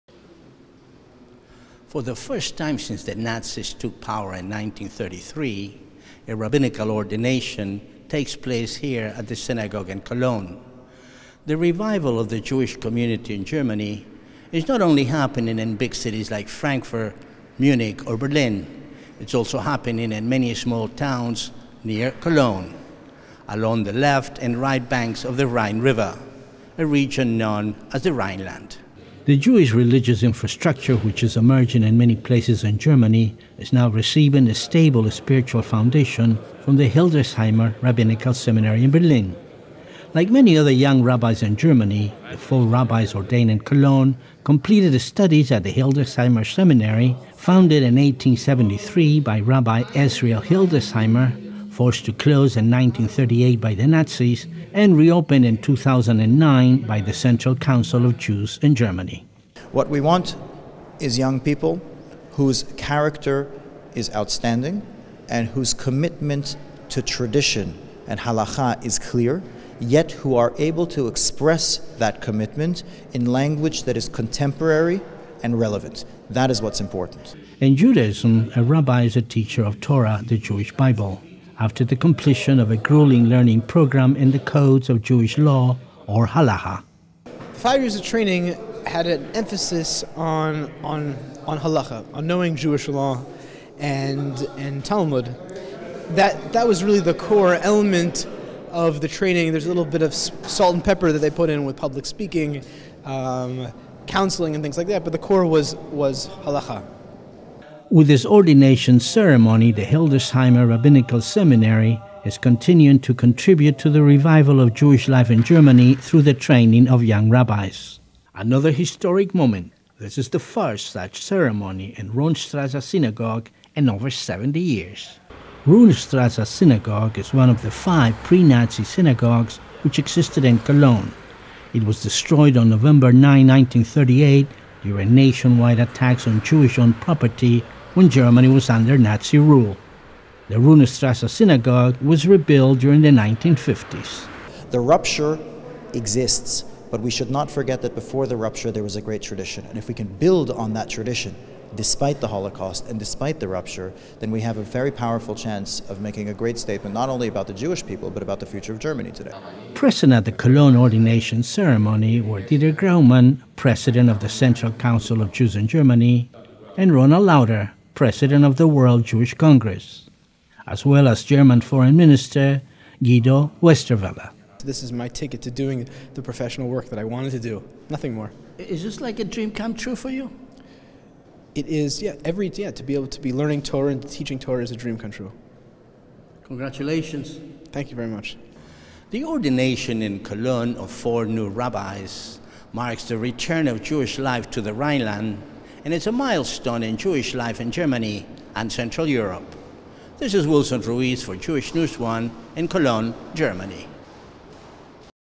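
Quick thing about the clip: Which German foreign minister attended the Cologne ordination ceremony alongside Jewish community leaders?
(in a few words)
Guido Westerwelle.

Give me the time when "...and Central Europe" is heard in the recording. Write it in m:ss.
3:18.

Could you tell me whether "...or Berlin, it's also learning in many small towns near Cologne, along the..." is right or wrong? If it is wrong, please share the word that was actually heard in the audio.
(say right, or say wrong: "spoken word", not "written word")
wrong: "happening", not "learning".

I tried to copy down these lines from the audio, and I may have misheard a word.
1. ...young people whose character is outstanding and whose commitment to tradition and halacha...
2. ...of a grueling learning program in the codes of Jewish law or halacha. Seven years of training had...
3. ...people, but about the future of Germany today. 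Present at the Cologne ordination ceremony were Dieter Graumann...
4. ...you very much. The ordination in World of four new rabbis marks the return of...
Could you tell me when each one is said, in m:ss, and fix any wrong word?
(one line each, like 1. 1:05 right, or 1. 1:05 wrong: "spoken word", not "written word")
1. 1:01 right
2. 1:22 wrong: "Five", not "Seven"
3. 2:37 right
4. 3:07 wrong: "Cologne", not "World".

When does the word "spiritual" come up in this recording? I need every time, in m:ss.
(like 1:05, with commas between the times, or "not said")
0:35.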